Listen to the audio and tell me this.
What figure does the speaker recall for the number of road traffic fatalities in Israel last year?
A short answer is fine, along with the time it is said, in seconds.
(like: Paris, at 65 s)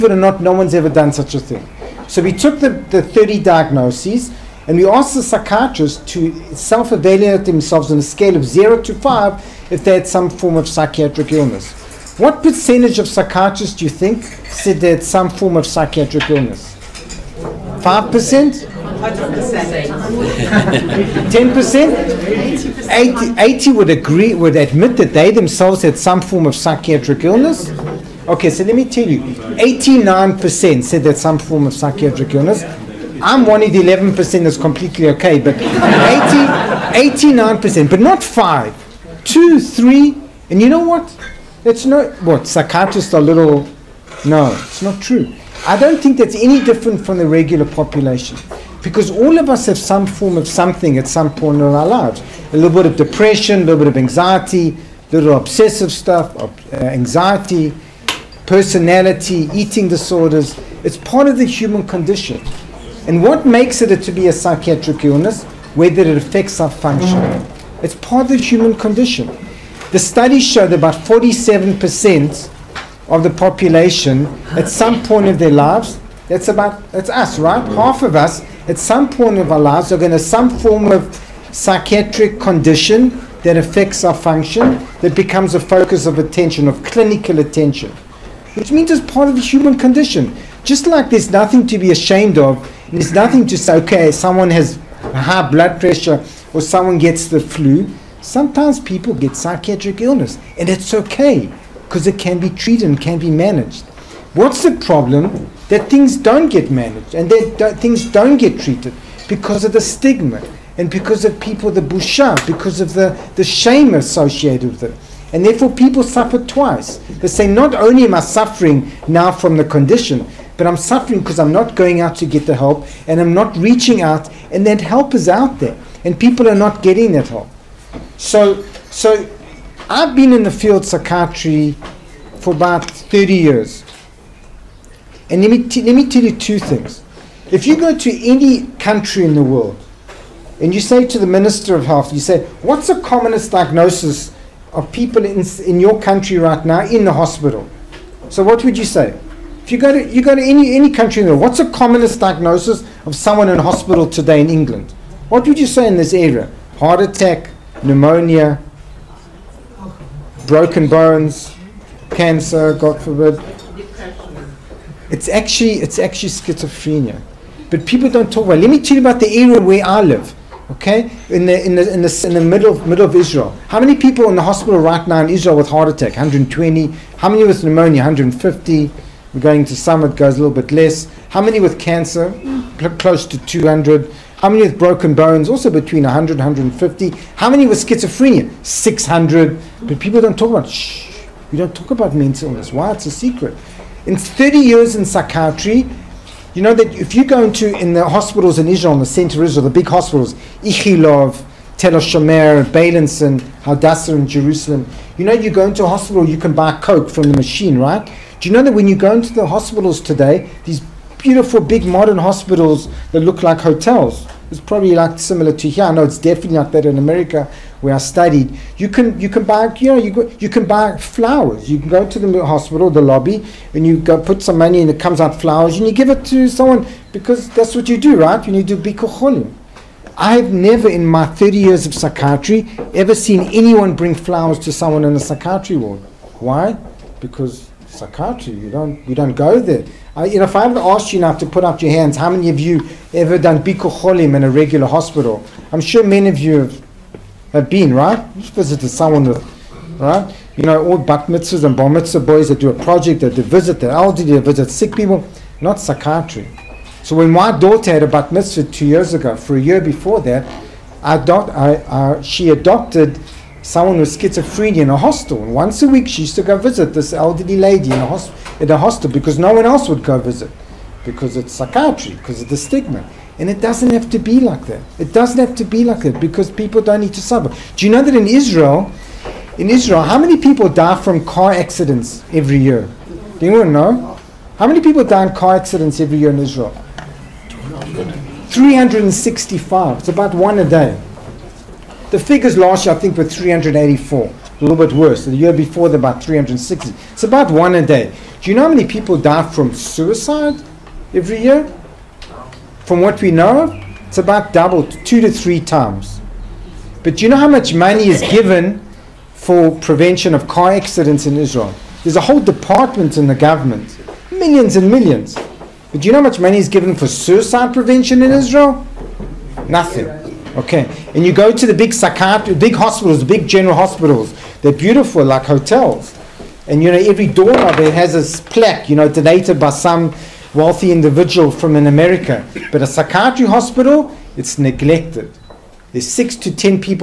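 384, at 293 s.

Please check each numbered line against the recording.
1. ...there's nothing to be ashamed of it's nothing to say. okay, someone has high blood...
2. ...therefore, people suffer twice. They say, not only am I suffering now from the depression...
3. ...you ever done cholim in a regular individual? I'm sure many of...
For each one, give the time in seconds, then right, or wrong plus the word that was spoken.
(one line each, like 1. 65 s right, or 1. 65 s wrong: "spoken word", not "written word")
1. 91 s right
2. 115 s wrong: "condition", not "depression"
3. 242 s wrong: "hospital", not "individual".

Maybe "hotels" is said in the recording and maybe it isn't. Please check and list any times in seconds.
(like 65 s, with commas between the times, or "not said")
213 s, 325 s.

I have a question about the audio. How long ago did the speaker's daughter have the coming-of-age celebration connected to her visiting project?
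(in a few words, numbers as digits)
2 years ago.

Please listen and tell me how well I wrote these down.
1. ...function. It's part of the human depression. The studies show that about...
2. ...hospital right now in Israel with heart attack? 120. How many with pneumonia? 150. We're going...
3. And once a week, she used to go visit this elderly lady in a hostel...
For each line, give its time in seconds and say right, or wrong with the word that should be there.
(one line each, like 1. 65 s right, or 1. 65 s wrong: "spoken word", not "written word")
1. 66 s wrong: "condition", not "depression"
2. 174 s right
3. 265 s right.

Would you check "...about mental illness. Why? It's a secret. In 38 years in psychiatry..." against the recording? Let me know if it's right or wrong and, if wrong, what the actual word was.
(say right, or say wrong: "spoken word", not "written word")
wrong: "30", not "38".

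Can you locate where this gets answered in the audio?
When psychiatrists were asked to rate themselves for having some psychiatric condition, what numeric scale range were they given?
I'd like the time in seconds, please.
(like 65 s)
8 s.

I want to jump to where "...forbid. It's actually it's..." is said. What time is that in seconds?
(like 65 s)
162 s.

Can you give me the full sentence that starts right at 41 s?
It's not, what, psychiatrists are little, no, it's not true.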